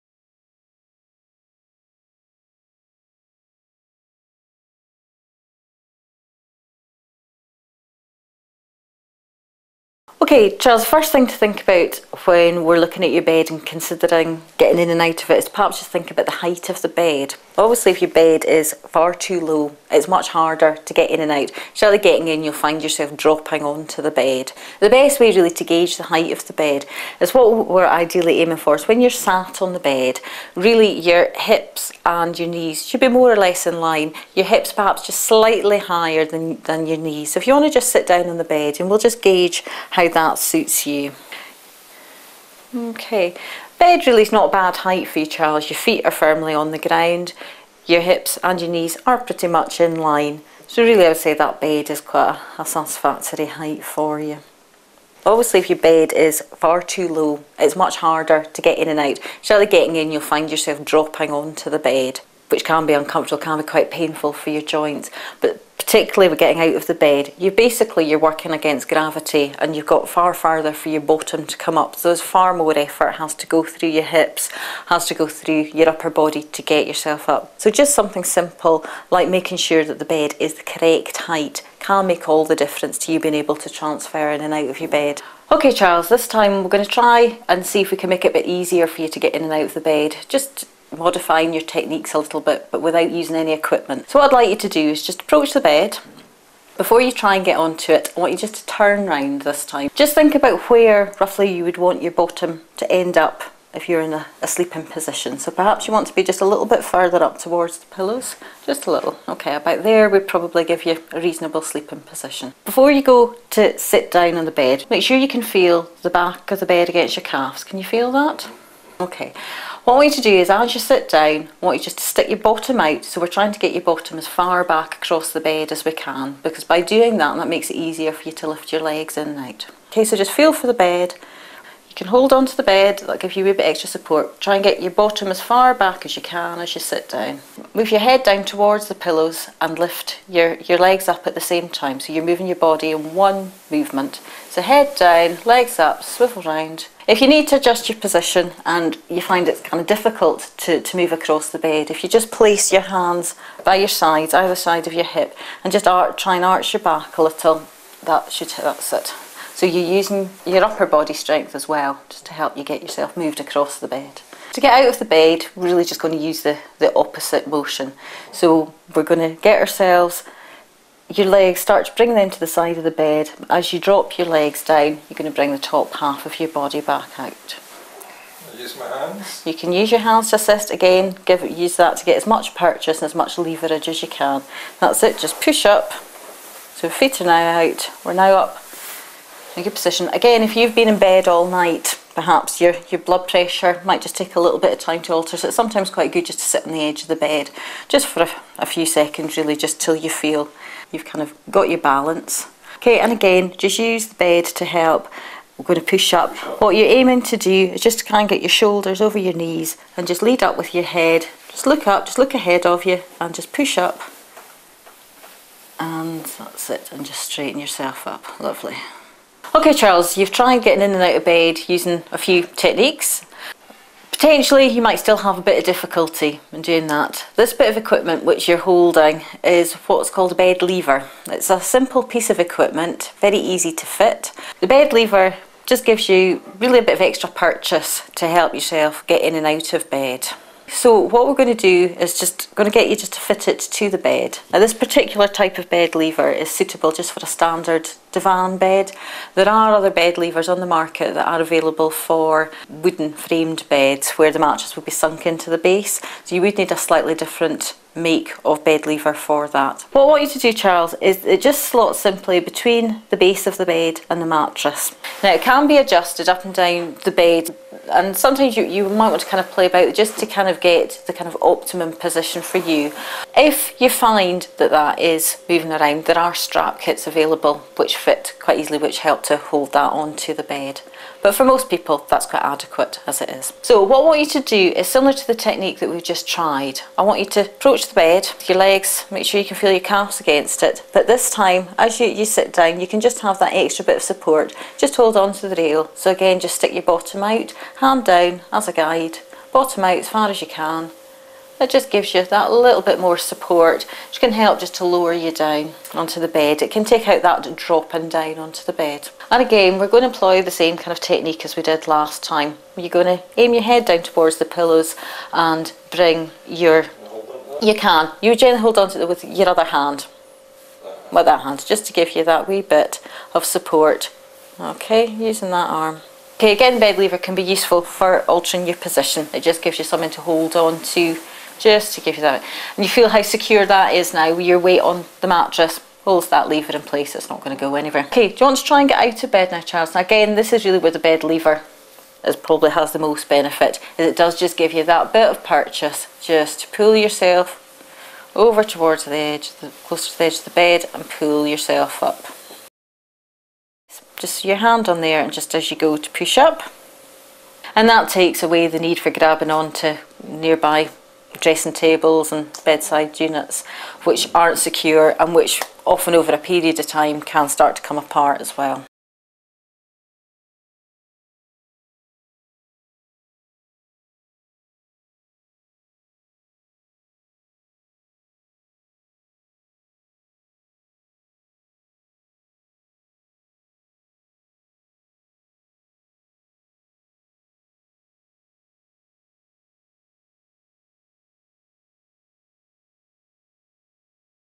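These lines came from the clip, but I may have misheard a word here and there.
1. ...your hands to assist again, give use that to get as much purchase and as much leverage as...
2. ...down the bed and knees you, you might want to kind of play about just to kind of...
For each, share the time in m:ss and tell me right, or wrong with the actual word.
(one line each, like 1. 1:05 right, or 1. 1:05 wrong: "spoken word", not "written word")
1. 2:59 right
2. 4:26 wrong: "sometimes", not "knees".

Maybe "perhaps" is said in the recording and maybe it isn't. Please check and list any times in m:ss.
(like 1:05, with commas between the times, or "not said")
0:15, 0:34, 1:45, 3:12.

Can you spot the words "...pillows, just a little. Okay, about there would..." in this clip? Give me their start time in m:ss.
1:47.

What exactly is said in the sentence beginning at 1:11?
So there's far more effort has to go through your hips, has to go through your upper body to get yourself up.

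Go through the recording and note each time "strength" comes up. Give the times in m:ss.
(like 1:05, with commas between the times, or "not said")
2:41.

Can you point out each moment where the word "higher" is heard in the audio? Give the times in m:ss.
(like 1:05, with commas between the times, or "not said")
0:35.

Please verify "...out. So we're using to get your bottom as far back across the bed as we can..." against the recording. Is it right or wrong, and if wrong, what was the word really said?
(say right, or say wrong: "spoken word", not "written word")
wrong: "trying", not "using".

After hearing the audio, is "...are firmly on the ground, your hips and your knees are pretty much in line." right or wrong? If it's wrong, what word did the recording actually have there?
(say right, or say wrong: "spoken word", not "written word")
right.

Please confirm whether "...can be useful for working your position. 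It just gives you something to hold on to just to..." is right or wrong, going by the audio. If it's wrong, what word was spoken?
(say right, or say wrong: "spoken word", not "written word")
wrong: "altering", not "working".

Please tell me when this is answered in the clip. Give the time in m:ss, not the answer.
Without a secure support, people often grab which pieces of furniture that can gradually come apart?
6:01.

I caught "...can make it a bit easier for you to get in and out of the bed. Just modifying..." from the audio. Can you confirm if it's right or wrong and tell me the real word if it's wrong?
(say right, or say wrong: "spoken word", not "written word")
right.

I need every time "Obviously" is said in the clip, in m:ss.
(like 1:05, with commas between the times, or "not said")
0:17, 0:55.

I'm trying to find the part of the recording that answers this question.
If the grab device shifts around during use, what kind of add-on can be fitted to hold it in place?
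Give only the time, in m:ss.
4:36.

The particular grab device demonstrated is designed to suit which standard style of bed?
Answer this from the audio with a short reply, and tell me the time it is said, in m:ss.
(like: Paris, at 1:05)
divan bed, at 4:08.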